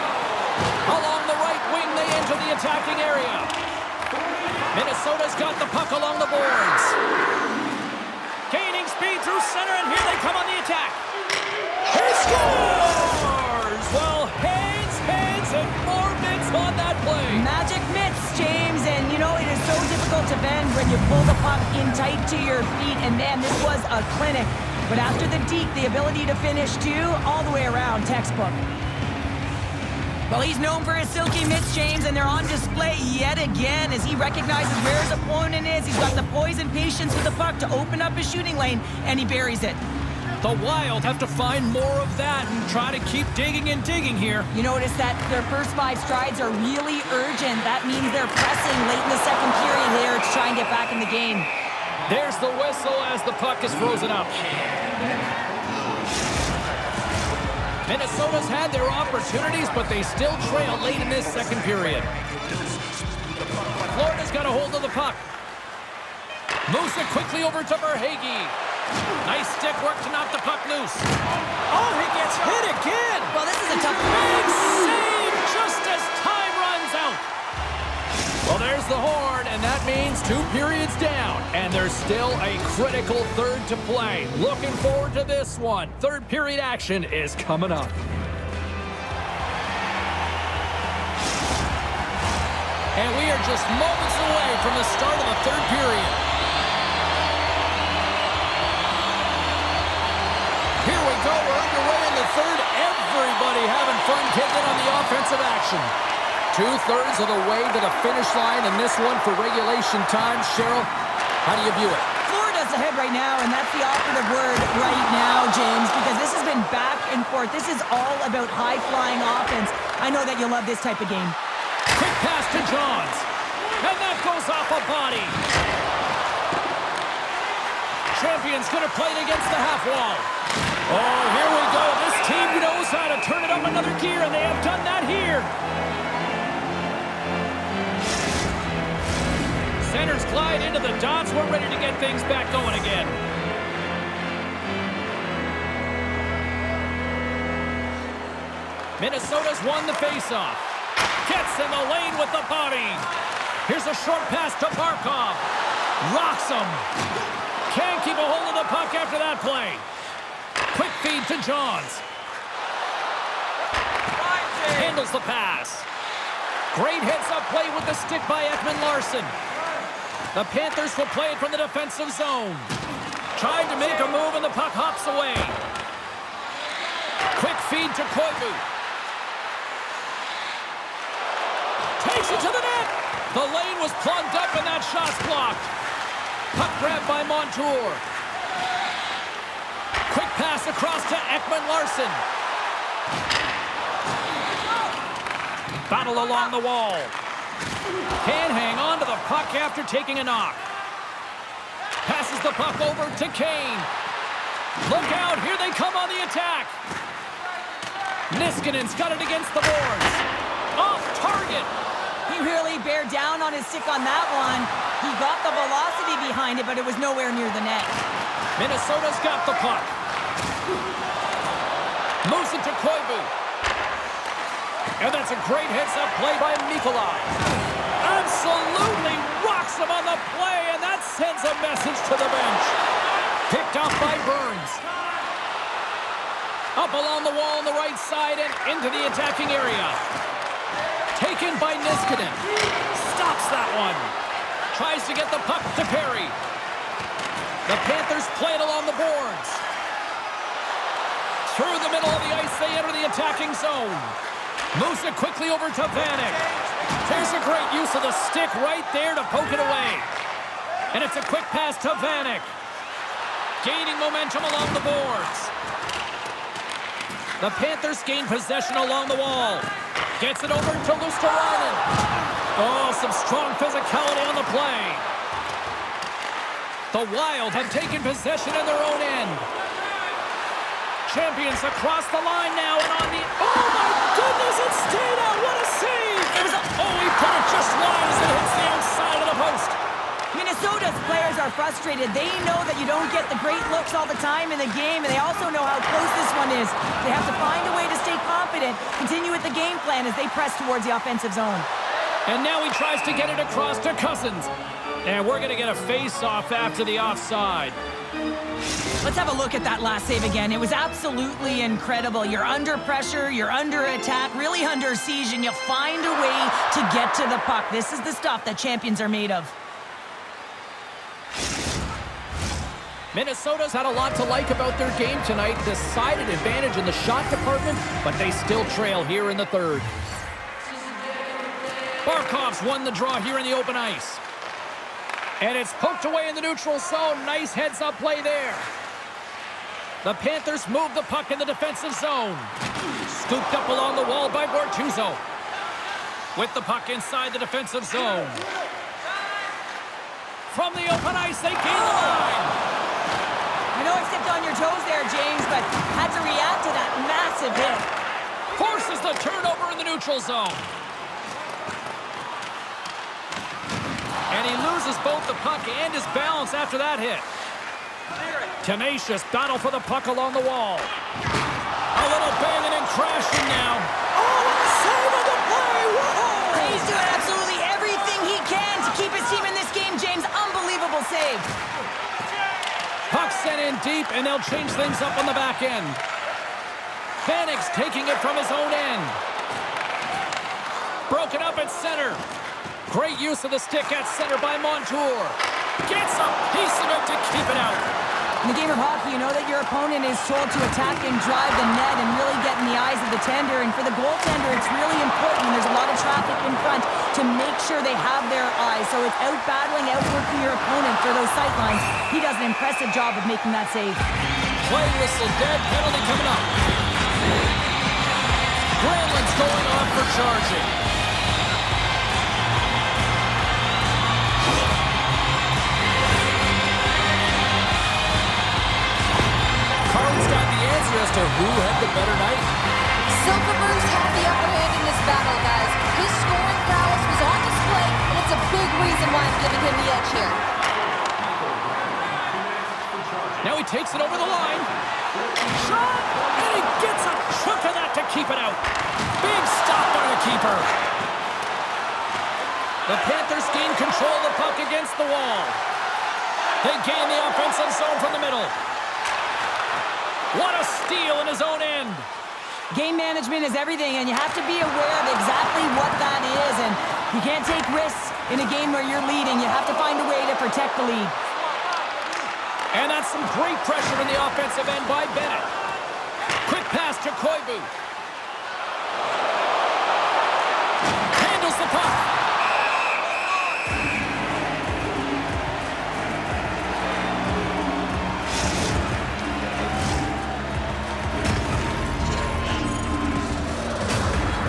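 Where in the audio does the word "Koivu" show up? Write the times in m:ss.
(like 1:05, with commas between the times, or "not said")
2:58, 3:42, 7:57.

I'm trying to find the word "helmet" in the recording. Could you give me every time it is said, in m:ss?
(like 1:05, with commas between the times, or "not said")
not said.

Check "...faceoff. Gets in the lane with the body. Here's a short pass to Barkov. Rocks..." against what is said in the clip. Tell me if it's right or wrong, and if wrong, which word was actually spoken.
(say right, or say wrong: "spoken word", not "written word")
right.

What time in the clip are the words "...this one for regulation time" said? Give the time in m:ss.
1:48.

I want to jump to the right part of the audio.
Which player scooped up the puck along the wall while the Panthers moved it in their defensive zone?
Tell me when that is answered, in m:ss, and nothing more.
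5:44.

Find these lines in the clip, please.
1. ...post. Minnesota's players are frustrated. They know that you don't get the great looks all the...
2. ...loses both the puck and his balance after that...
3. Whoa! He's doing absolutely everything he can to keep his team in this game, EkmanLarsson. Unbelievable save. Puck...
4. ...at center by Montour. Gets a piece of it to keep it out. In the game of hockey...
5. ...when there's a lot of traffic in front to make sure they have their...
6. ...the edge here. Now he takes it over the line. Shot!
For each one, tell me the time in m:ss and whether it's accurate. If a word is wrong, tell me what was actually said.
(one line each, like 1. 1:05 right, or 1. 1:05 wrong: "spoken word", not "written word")
1. 4:49 right
2. 6:04 right
3. 6:15 wrong: "James", not "EkmanLarsson"
4. 6:33 right
5. 6:45 right
6. 7:19 right.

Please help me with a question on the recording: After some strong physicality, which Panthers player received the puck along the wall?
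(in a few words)
Luostarinen.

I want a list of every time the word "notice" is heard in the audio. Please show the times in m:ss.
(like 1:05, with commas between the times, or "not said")
0:44.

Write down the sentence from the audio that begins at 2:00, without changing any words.
I know that you'll love this type of game.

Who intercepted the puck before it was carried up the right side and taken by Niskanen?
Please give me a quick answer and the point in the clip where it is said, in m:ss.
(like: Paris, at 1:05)
Burns, at 3:54.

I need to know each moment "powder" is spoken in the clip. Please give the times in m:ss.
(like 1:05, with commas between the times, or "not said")
not said.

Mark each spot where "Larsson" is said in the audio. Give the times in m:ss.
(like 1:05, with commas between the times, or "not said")
2:48, 3:11.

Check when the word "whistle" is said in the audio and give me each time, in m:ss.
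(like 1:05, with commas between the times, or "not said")
0:52, 6:55.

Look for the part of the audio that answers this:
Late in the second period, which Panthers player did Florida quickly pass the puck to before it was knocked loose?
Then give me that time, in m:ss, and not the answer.
1:07.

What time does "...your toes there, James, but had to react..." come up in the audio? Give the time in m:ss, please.
5:54.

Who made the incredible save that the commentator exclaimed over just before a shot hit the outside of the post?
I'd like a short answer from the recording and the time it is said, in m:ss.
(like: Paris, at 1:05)
Tito, at 4:44.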